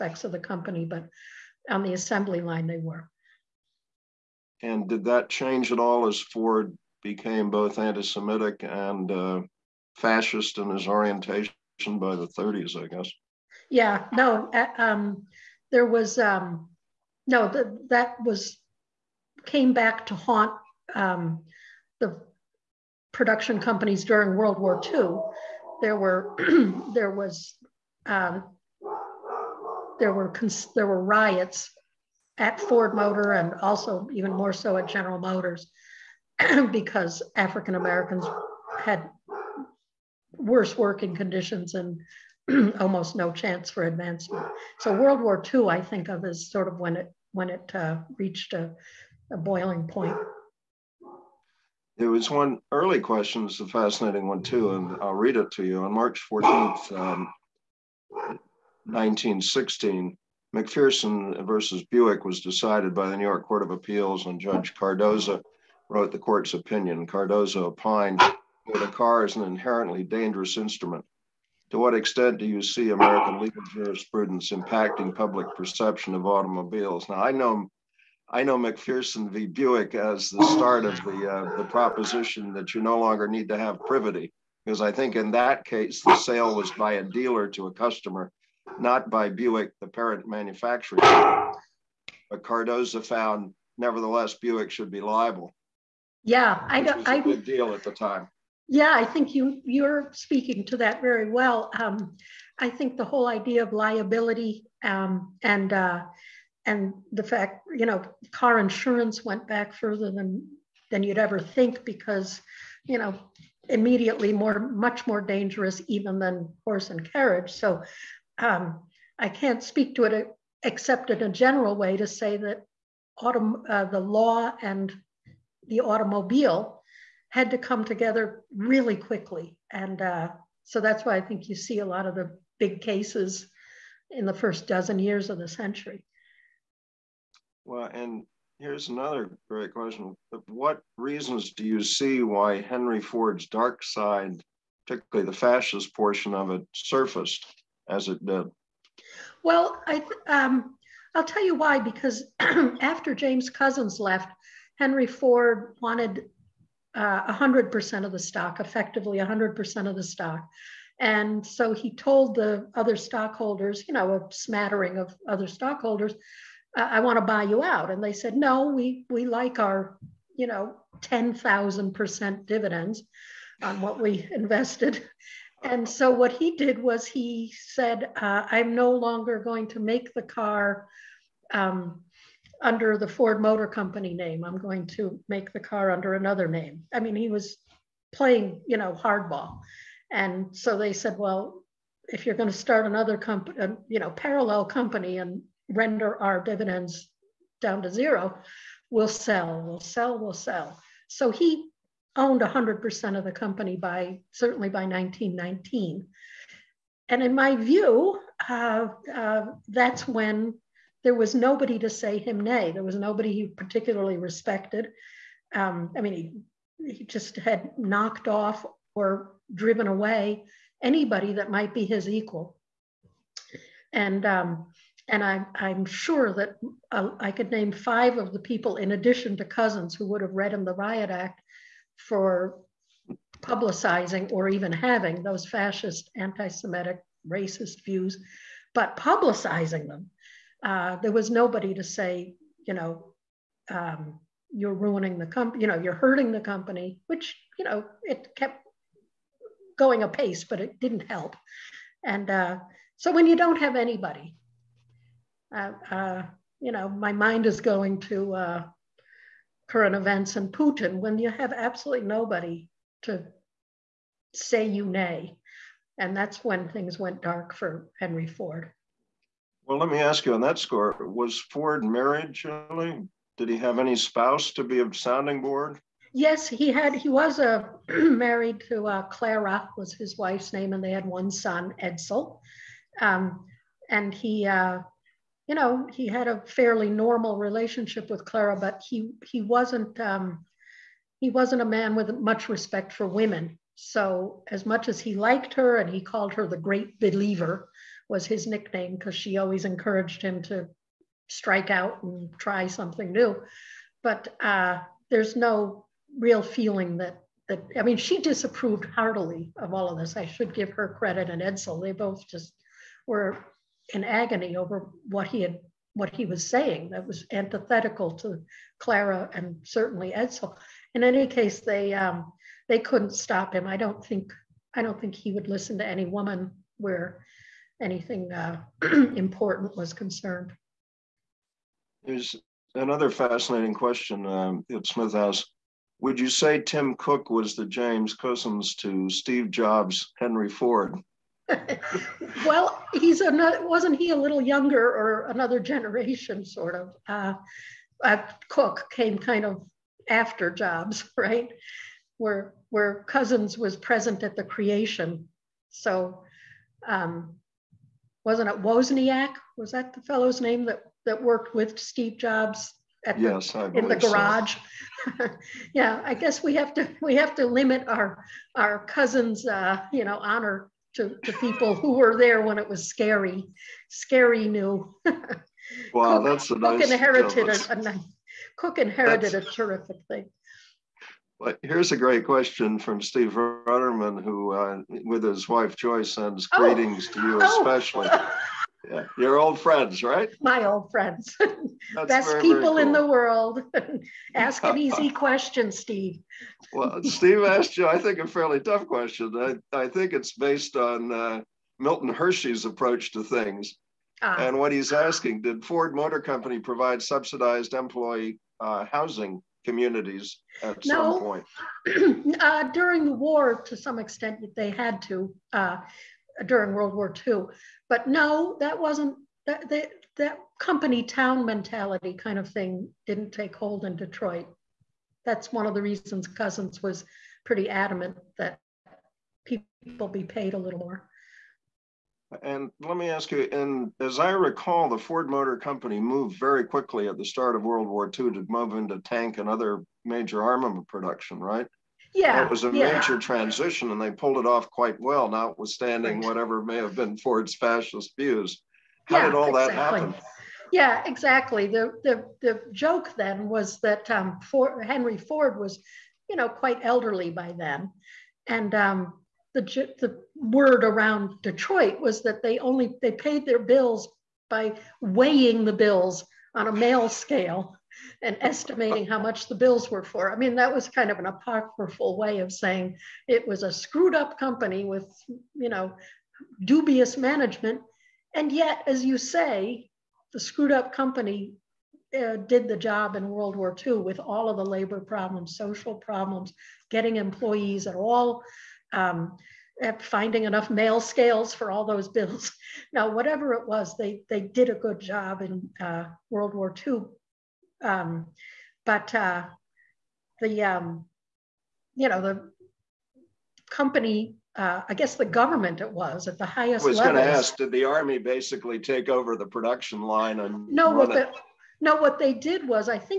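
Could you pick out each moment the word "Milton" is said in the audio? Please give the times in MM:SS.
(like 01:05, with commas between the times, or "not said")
06:41.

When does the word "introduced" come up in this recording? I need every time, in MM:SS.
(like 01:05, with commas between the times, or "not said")
not said.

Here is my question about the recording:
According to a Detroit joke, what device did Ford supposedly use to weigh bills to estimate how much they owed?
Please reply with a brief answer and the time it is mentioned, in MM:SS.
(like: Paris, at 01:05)
mail scale, at 07:46.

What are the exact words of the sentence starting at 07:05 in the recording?
That's one of the reasons Cousins was pretty adamant that people be paid a little more.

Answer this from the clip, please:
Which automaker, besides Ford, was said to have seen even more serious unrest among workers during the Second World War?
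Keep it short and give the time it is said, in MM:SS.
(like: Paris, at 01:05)
General Motors, at 00:34.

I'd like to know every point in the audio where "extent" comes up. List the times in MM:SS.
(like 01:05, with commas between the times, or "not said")
01:11, 06:53.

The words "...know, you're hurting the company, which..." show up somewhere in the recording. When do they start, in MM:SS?
04:05.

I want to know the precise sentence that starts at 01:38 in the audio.
Yeah, I think you you're speaking to that very well.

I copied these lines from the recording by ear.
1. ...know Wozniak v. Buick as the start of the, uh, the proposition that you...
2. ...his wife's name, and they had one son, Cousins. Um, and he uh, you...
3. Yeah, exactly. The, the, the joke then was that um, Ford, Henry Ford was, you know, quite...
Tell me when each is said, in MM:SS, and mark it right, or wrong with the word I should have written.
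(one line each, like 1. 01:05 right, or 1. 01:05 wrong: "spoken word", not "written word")
1. 01:18 wrong: "MacPherson", not "Wozniak"
2. 04:39 wrong: "Edsel", not "Cousins"
3. 07:30 right.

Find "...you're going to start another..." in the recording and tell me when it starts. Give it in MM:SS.
03:12.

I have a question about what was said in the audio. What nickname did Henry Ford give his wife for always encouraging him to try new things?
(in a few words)
the great believer.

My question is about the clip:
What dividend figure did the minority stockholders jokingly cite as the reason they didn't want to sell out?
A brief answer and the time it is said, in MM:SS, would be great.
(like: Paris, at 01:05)
10,000%, at 02:51.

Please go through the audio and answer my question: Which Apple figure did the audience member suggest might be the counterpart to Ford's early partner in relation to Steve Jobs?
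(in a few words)
Tim Cook.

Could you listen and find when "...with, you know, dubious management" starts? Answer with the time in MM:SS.
07:54.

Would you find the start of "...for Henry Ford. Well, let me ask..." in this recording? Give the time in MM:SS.
04:27.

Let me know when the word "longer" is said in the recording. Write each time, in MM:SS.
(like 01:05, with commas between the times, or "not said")
01:22, 02:58.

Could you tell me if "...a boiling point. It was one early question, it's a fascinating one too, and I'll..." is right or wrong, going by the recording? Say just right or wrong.
right.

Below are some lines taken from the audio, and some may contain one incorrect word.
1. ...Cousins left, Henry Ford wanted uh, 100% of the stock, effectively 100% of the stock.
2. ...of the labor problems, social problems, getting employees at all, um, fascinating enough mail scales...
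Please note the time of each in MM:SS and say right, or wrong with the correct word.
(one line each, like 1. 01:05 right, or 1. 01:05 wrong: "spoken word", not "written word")
1. 02:33 right
2. 08:04 wrong: "finding", not "fascinating".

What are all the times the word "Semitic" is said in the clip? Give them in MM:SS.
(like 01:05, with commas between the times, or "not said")
00:08, 03:56.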